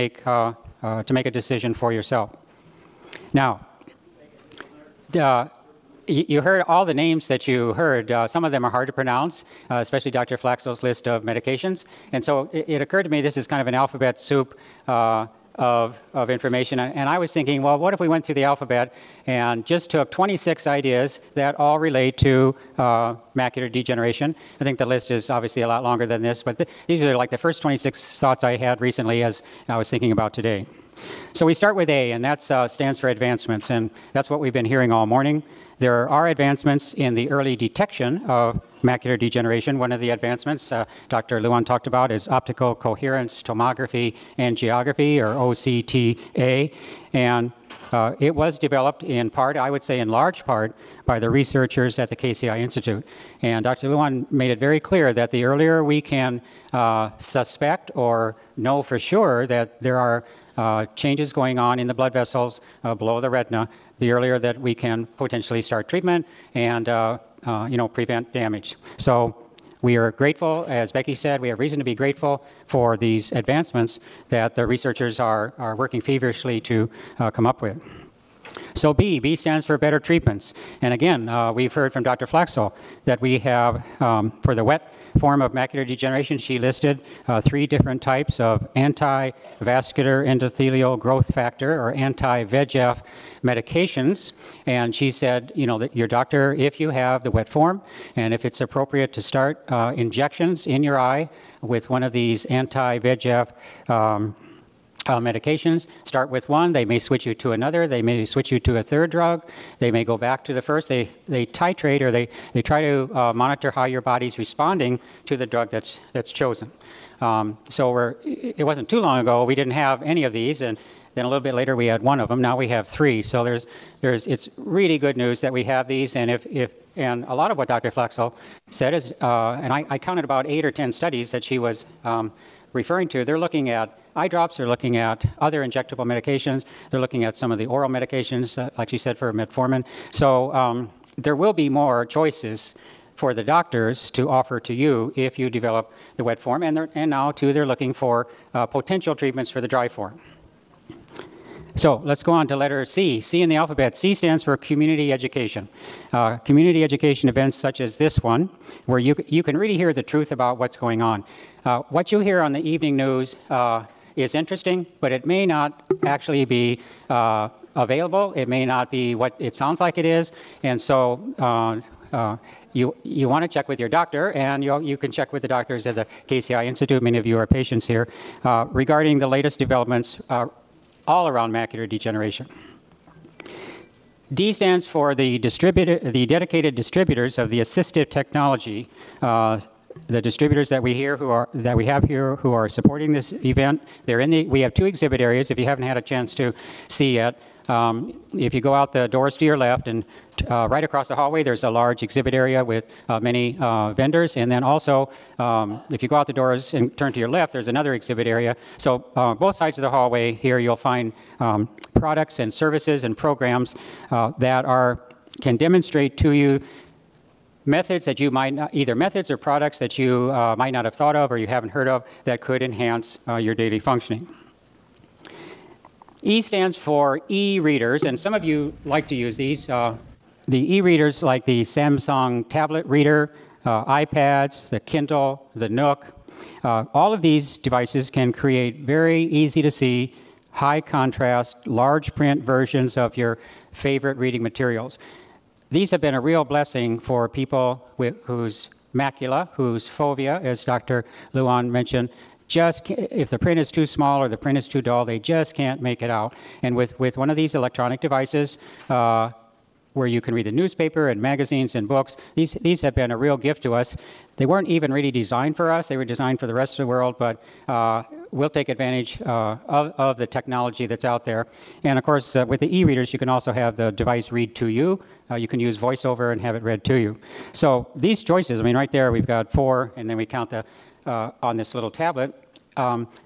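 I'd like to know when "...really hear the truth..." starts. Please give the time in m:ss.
2:39.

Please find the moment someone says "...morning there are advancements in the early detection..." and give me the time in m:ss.
0:35.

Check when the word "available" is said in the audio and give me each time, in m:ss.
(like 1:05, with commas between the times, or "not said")
2:47.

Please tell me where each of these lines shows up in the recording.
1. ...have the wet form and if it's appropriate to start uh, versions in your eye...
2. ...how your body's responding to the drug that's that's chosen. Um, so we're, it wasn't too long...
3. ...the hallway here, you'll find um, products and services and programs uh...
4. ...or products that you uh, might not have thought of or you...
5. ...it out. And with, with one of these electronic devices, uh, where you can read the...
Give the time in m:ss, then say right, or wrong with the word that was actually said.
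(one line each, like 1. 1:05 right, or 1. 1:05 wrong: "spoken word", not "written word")
1. 1:36 wrong: "injections", not "versions"
2. 1:53 right
3. 3:29 right
4. 3:39 right
5. 4:16 right.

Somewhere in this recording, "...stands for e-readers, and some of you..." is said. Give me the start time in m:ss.
3:46.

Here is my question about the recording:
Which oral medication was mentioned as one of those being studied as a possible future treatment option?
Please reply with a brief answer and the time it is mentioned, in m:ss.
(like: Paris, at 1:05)
metformin, at 2:19.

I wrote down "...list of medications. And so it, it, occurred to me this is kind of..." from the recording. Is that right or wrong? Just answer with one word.
right.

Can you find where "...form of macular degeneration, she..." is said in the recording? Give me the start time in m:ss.
1:25.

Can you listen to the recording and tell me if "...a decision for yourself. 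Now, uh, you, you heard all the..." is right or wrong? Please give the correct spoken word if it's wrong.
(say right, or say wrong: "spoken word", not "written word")
right.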